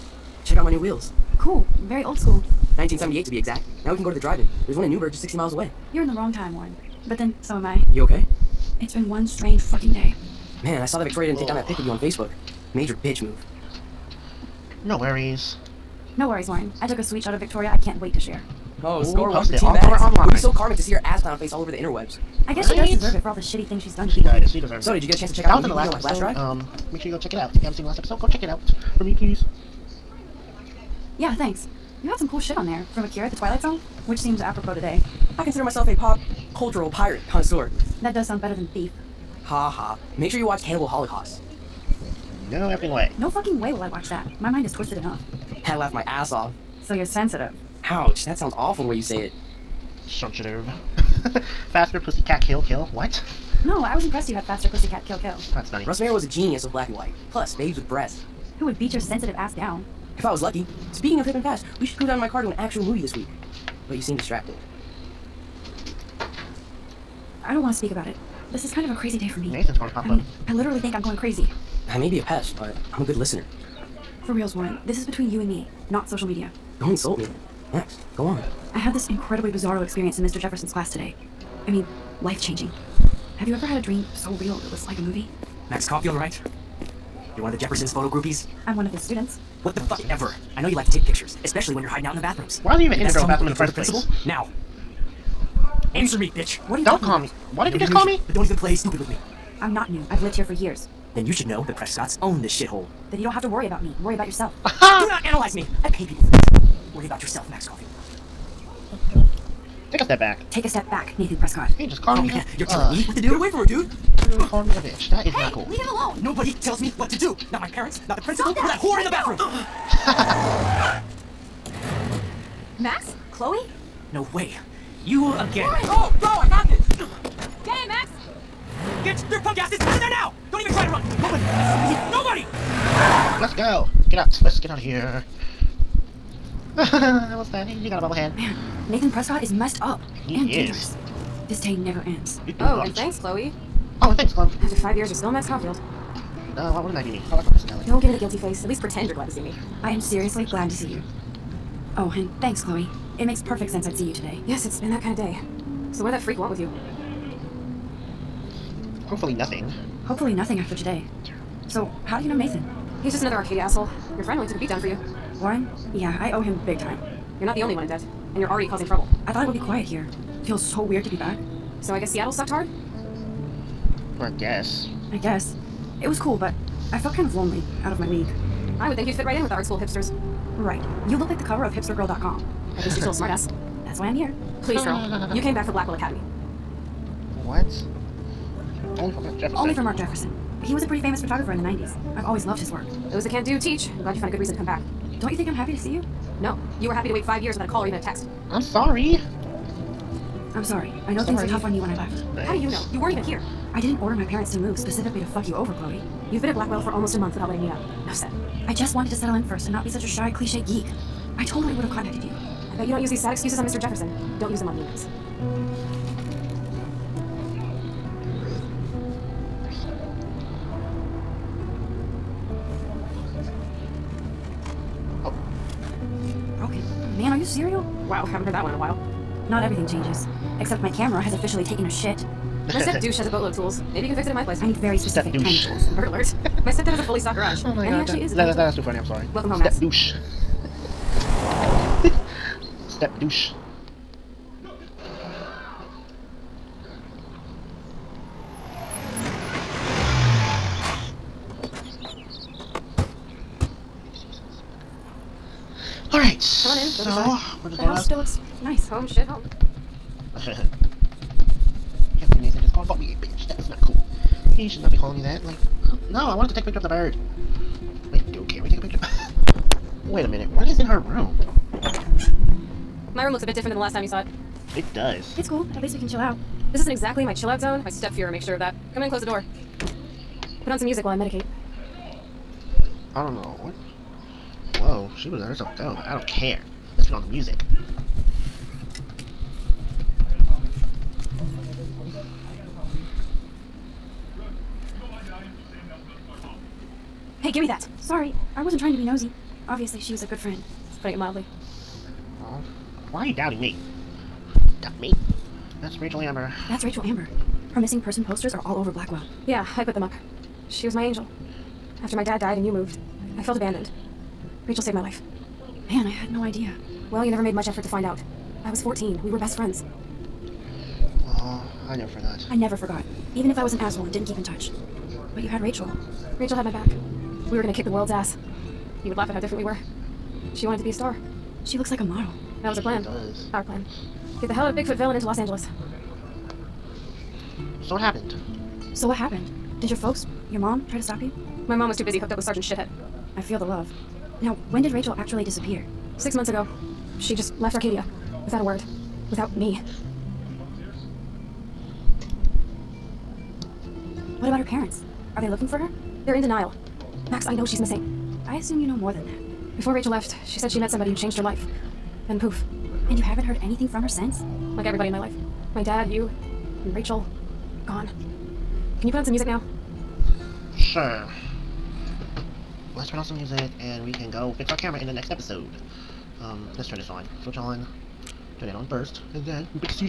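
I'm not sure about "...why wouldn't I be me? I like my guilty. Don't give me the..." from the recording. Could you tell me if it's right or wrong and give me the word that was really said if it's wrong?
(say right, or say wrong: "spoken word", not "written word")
wrong: "personality", not "guilty".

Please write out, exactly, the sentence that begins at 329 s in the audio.
You would laugh at how different we were.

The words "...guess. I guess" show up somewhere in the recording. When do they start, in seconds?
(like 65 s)
174 s.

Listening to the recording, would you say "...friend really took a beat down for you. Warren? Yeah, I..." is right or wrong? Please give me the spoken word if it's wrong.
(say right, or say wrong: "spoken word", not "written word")
right.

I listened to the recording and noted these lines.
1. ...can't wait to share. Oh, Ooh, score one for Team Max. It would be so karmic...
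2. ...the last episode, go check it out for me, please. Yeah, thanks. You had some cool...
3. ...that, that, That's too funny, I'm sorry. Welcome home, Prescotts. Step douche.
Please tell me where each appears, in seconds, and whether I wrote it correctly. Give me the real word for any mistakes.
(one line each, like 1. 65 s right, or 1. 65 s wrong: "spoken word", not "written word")
1. 17 s right
2. 27 s right
3. 238 s wrong: "Matt", not "Prescotts".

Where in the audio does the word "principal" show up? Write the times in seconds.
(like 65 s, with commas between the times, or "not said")
93 s, 118 s.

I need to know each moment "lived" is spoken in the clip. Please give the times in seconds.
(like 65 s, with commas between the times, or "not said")
100 s.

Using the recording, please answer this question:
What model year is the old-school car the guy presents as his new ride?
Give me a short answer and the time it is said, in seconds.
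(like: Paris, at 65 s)
1978, at 2 s.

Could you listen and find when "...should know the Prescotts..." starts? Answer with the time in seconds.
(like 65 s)
101 s.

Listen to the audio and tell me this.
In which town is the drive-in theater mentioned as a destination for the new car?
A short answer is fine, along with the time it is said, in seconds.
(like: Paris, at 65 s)
Newberg, at 4 s.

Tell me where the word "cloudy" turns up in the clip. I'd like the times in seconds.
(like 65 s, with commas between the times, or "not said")
not said.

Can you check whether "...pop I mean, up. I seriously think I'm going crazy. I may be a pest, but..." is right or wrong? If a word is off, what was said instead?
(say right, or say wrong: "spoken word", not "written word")
wrong: "literally", not "seriously".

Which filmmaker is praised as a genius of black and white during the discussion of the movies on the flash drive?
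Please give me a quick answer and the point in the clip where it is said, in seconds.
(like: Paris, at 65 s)
Russ Meyer, at 55 s.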